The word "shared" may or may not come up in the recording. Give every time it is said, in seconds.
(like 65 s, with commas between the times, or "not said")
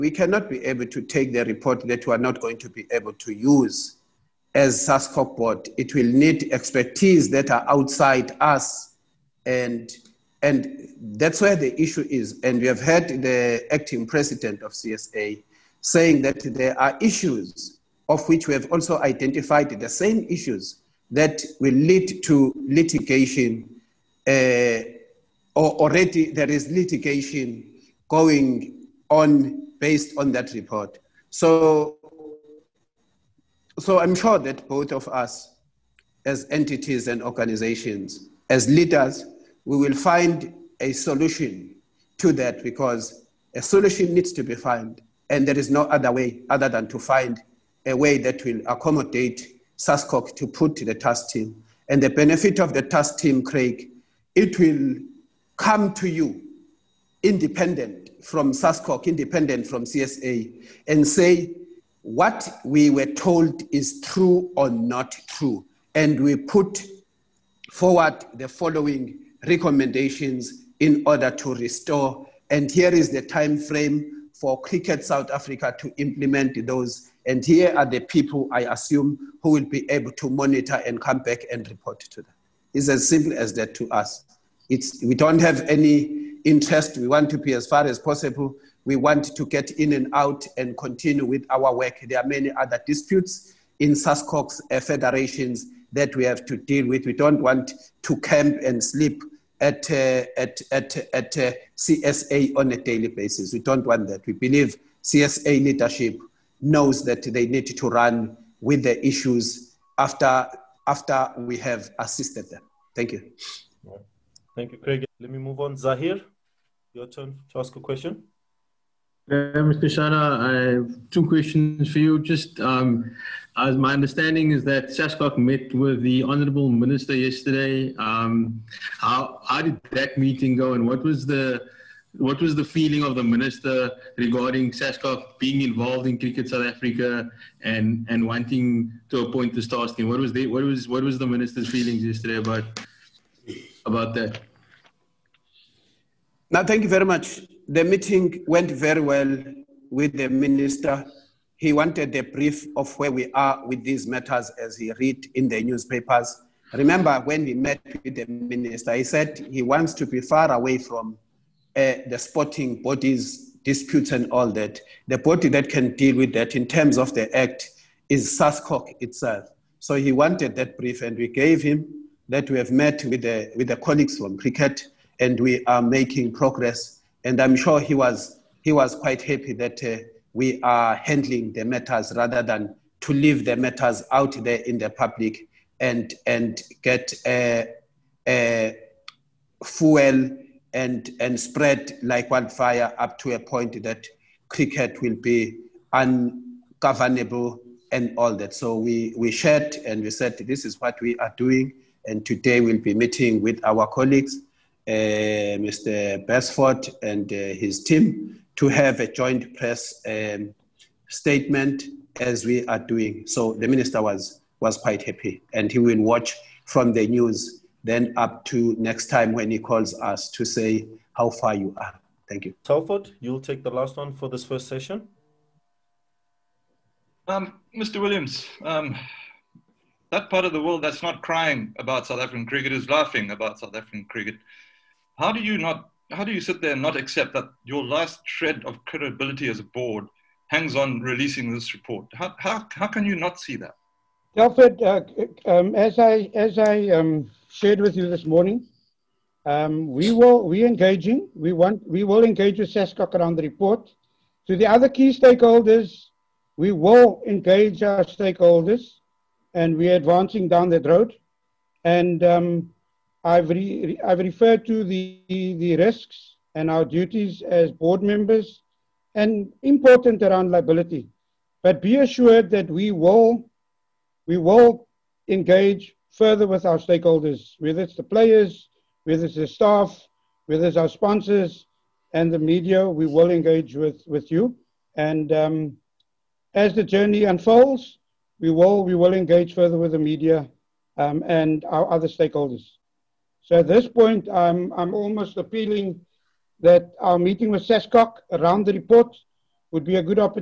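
199 s, 247 s.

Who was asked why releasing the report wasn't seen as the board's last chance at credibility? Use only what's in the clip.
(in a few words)
Mr. Williams.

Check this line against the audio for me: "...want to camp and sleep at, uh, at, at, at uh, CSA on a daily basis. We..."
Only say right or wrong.
right.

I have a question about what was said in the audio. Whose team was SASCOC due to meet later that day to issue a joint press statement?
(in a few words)
Mr. Beresford.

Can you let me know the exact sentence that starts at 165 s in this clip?
The body that can deal with that in terms of the act is SASCOC itself.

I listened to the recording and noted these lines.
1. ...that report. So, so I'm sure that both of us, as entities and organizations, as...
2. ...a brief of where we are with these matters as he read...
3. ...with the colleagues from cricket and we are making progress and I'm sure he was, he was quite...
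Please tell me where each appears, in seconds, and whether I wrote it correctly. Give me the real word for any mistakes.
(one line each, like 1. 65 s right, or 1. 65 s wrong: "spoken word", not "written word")
1. 30 s right
2. 152 s right
3. 173 s right.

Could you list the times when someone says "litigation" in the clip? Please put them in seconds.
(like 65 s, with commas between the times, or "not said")
22 s, 26 s.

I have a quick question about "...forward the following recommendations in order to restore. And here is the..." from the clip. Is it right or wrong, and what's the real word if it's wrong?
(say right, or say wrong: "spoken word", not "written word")
right.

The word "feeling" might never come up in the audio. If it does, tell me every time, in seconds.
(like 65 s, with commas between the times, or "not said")
132 s, 141 s.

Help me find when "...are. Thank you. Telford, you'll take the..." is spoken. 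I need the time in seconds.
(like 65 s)
221 s.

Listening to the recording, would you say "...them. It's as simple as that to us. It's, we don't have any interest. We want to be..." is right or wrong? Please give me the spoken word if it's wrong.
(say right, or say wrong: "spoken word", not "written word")
right.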